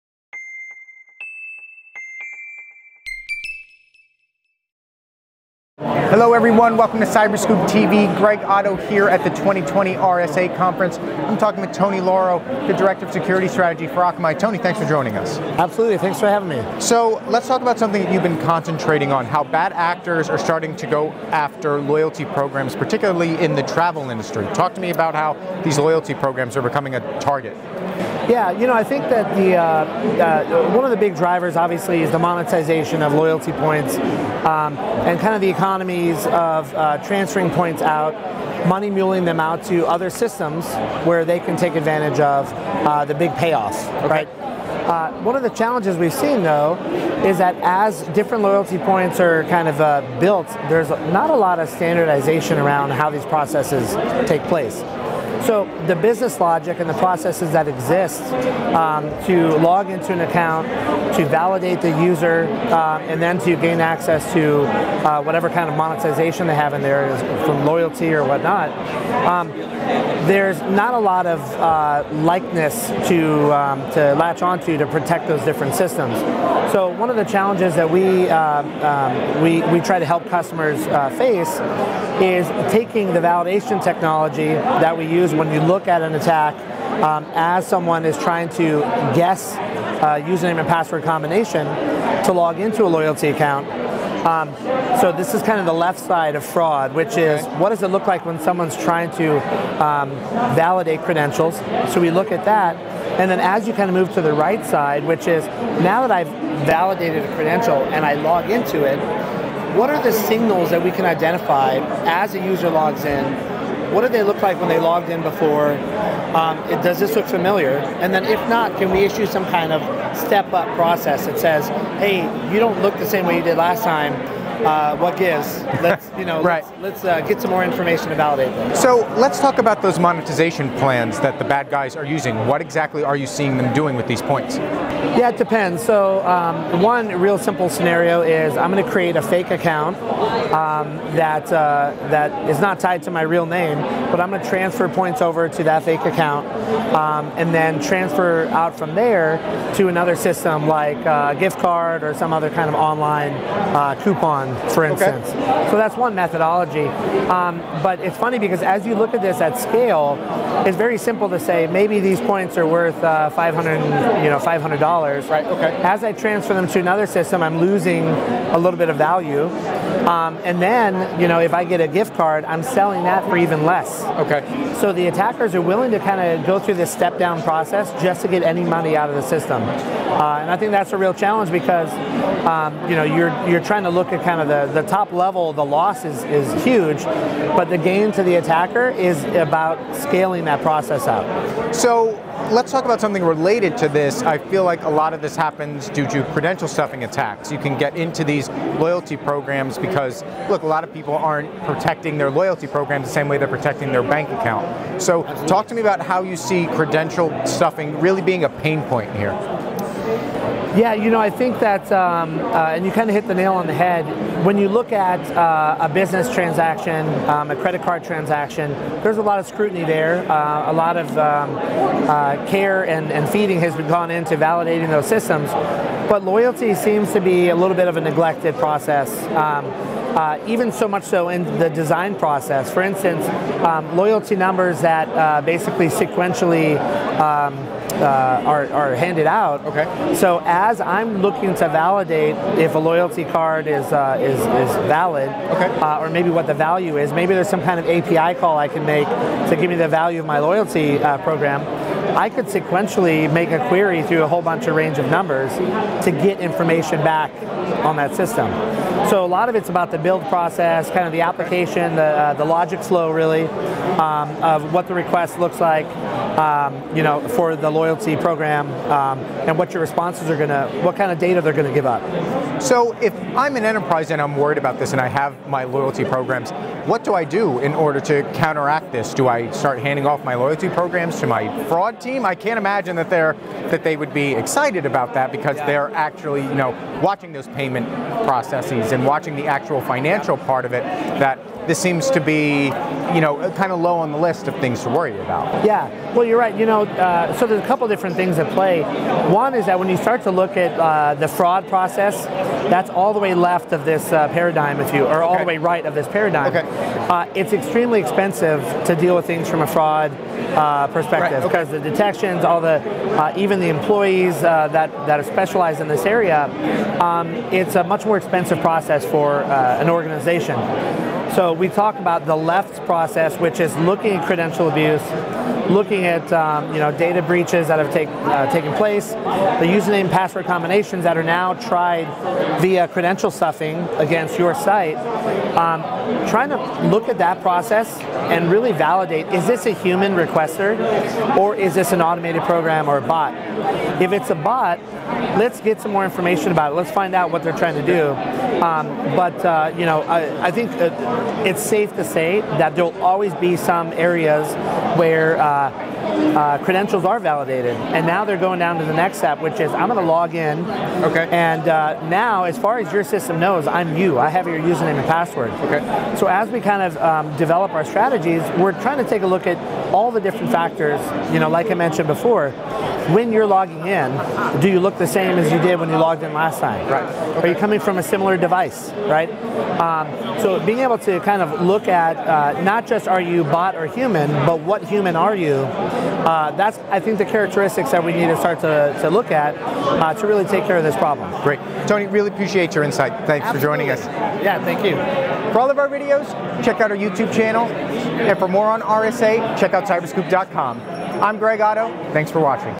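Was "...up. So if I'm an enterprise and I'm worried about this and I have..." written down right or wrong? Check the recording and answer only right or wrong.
right.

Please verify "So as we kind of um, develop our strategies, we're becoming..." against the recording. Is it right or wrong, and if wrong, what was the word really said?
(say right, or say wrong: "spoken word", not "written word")
wrong: "trying", not "becoming".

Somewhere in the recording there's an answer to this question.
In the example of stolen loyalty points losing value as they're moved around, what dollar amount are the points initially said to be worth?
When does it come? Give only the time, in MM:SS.
02:44.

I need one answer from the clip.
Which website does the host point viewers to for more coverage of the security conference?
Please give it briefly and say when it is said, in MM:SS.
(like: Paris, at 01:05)
cyberscoop.com, at 06:39.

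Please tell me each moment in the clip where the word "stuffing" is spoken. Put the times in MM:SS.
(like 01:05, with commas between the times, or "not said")
03:16, 03:27, 05:33.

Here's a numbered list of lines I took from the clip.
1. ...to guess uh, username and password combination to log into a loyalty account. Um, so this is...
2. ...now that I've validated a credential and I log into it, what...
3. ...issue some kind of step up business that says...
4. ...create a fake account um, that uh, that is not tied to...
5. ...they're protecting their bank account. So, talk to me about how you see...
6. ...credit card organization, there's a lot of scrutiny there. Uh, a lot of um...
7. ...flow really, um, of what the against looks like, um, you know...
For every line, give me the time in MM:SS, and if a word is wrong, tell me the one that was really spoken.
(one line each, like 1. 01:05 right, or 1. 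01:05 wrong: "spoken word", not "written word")
1. 01:28 right
2. 01:45 right
3. 01:58 wrong: "process", not "business"
4. 02:18 right
5. 03:23 right
6. 03:37 wrong: "transaction", not "organization"
7. 04:22 wrong: "request", not "against".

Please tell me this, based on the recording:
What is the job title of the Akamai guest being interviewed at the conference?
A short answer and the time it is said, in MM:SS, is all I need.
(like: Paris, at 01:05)
Director of Security Strategy, at 00:12.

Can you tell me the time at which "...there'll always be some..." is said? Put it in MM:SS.
05:52.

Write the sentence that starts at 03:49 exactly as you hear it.
Um, uh, even so much so in the design process.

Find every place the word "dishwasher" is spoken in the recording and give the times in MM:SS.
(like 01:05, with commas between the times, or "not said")
not said.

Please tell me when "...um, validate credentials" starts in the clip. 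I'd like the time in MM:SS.
01:39.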